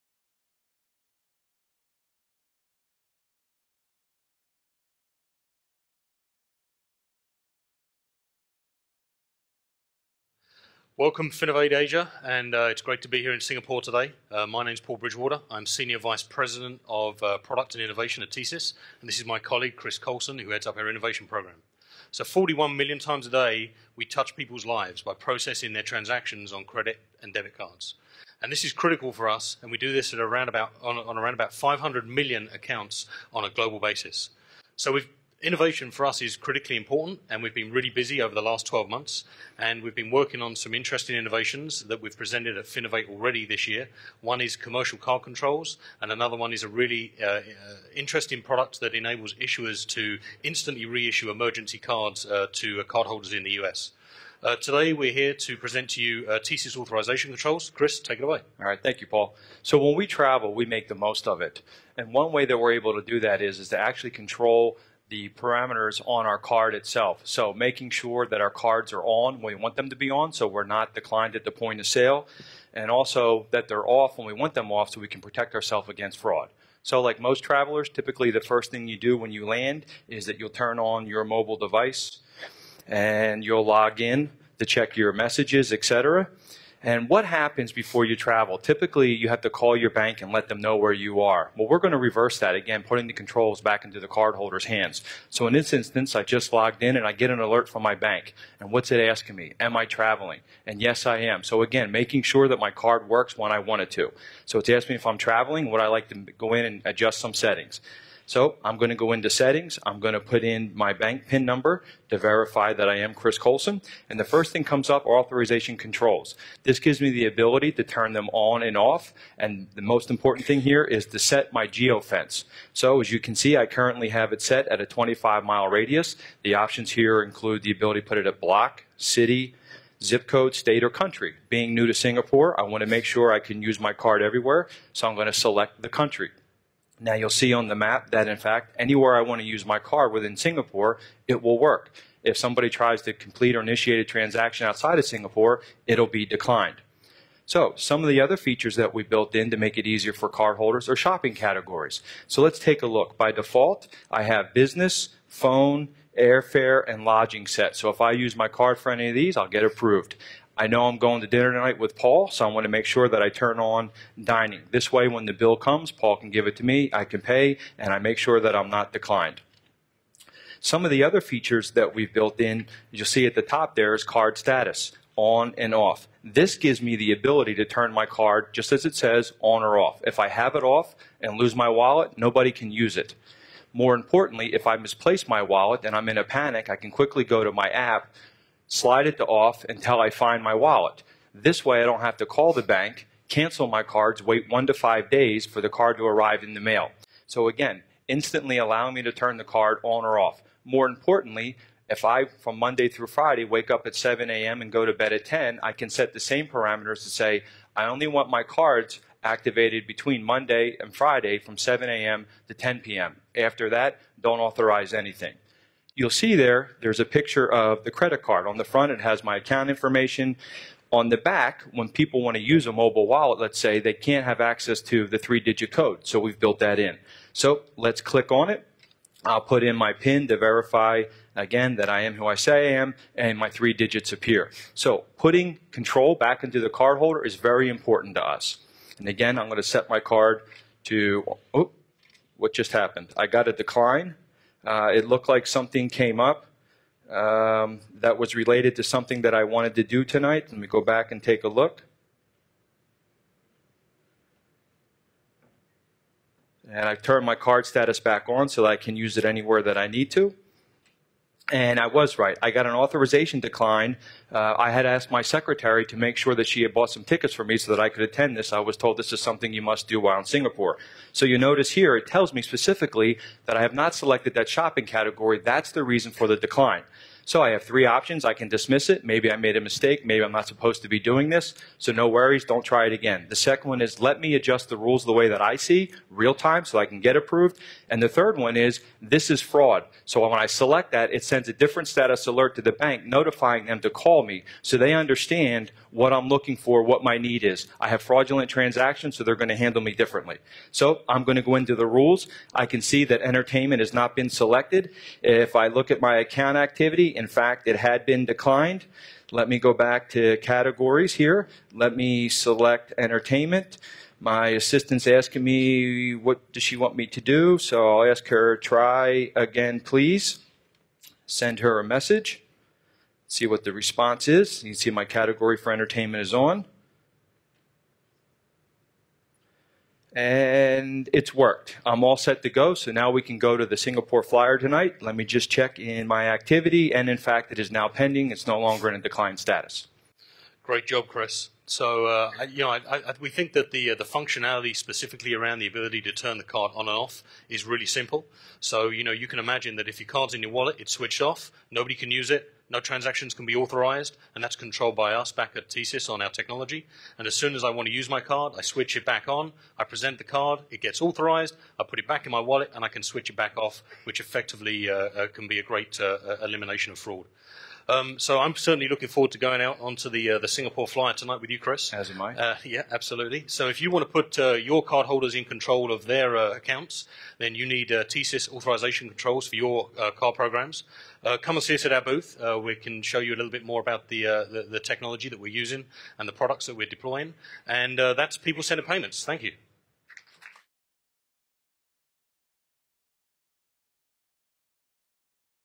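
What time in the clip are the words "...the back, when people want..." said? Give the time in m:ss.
3:41.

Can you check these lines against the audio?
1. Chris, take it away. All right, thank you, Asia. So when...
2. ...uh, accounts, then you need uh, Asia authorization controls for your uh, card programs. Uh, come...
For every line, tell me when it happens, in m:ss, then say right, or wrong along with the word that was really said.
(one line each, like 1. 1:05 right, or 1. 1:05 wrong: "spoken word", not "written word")
1. 0:57 wrong: "Paul", not "Asia"
2. 6:16 wrong: "TSYS", not "Asia".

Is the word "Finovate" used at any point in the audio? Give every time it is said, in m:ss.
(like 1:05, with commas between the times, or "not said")
0:11, 0:42.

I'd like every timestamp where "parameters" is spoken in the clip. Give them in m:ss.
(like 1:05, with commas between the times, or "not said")
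1:05, 3:26.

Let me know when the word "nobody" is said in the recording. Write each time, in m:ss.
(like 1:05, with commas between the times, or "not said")
3:02, 5:51.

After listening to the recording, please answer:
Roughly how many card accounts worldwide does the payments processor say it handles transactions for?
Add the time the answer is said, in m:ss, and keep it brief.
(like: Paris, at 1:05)
500 million, at 0:31.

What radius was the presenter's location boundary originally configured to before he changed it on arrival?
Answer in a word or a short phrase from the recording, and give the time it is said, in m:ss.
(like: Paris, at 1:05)
25 miles, at 2:04.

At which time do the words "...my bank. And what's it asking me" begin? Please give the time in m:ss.
1:37.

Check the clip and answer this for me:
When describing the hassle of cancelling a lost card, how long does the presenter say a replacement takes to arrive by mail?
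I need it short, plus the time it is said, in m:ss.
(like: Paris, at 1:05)
1 to 5 days, at 3:14.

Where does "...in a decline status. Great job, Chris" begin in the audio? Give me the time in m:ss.
5:38.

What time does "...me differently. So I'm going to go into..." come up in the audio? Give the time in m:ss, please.
4:59.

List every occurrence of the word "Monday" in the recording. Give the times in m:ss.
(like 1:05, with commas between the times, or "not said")
3:22, 3:30.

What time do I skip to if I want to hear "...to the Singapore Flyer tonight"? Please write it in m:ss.
5:33.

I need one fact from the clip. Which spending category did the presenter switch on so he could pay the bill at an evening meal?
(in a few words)
Dining.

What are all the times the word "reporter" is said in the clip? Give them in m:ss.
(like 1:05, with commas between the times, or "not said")
not said.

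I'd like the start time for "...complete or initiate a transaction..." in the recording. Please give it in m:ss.
2:23.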